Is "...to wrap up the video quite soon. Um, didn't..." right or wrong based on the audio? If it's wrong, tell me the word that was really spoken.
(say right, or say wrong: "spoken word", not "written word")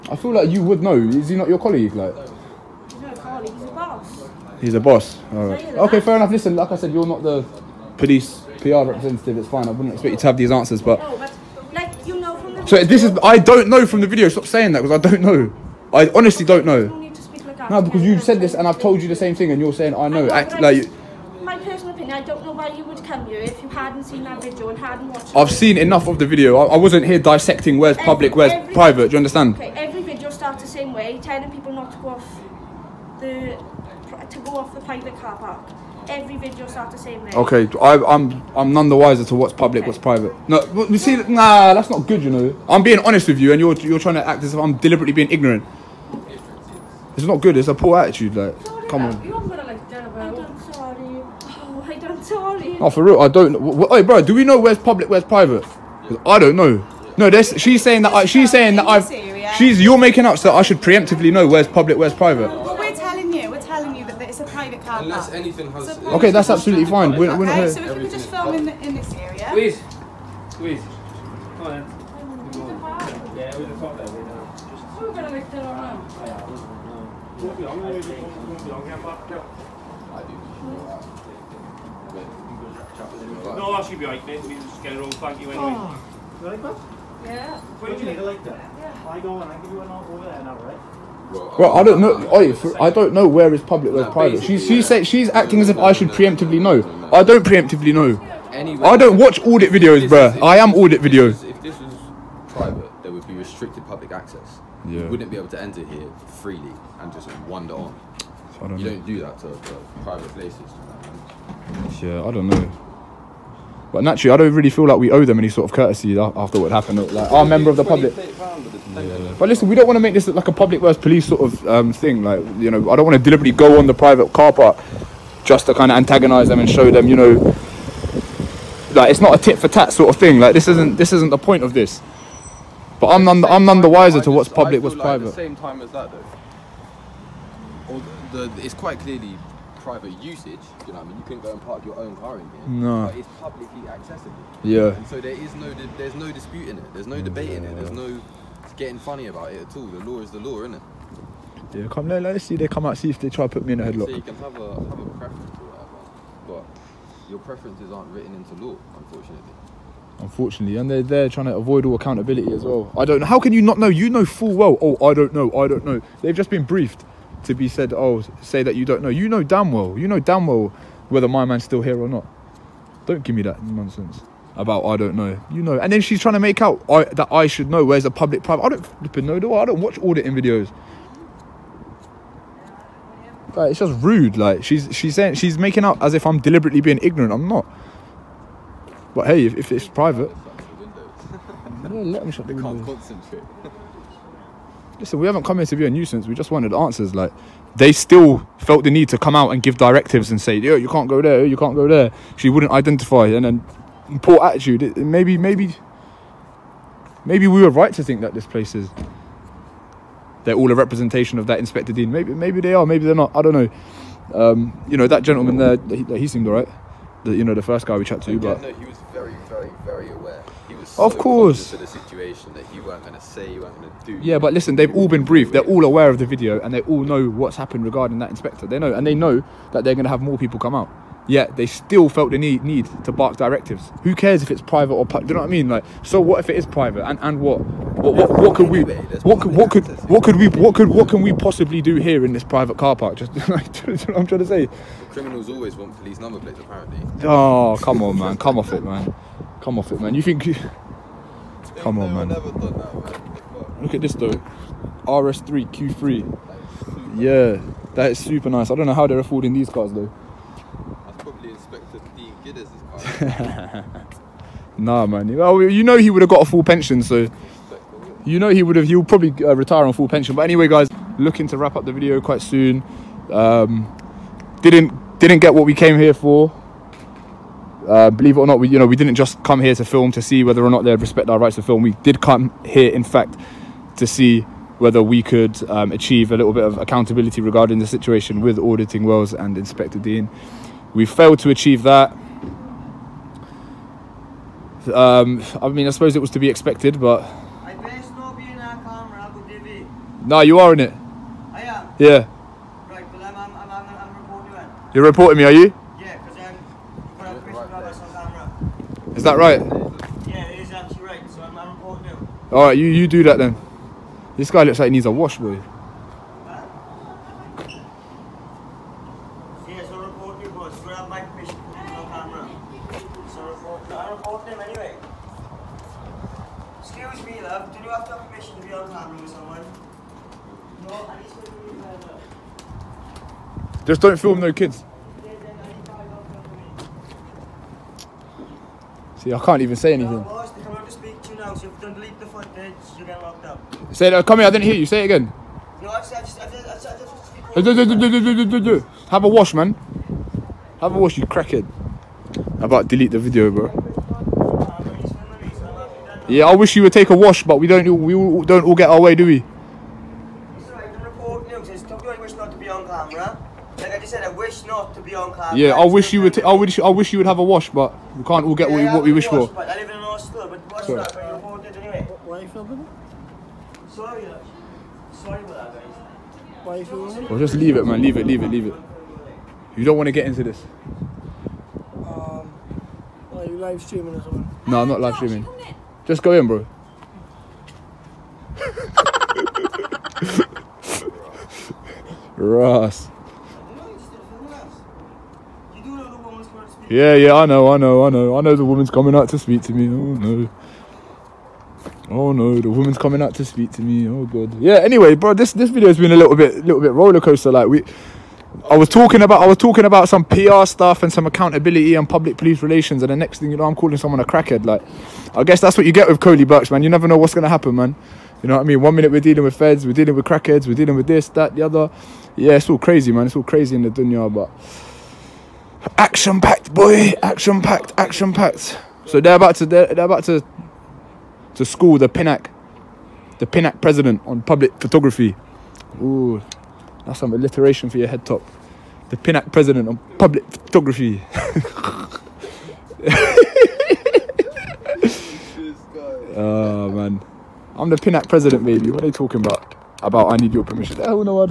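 right.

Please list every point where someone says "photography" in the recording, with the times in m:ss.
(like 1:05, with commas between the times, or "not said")
7:14, 7:20.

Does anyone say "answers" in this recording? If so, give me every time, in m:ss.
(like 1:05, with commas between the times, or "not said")
0:10, 3:16.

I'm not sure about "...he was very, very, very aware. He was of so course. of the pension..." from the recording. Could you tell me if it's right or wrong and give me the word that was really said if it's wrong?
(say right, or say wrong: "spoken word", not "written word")
wrong: "situation", not "pension".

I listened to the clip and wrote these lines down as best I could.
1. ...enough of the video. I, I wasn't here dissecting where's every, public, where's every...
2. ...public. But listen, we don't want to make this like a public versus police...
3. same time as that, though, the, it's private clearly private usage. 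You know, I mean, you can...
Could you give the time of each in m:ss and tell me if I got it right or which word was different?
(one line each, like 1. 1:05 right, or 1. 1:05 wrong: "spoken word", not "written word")
1. 0:25 right
2. 1:57 right
3. 2:15 wrong: "quite", not "private".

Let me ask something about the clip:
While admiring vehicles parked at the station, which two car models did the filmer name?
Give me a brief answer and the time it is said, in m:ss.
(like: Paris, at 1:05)
RS3 Q3, at 4:15.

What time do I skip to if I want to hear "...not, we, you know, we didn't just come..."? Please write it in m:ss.
4:38.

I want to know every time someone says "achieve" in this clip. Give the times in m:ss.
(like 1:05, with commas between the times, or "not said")
4:45, 4:51.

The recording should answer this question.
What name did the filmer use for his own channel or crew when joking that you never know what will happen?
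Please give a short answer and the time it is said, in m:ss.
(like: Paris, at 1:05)
Koleeberks, at 6:56.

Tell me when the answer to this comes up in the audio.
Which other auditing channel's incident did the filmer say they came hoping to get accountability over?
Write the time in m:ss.
4:48.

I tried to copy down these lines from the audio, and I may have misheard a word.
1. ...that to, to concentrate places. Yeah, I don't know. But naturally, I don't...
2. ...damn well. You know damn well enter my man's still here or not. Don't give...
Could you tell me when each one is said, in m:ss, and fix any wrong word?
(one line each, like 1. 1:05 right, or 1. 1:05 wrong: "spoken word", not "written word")
1. 1:49 wrong: "private", not "concentrate"
2. 2:49 wrong: "whether", not "enter".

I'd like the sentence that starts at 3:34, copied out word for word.
Um, you know that gentleman there.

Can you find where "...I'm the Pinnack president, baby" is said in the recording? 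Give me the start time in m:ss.
7:27.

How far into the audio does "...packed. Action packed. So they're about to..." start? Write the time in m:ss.
7:07.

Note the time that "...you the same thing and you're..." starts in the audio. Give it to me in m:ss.
0:19.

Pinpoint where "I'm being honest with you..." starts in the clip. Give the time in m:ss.
0:42.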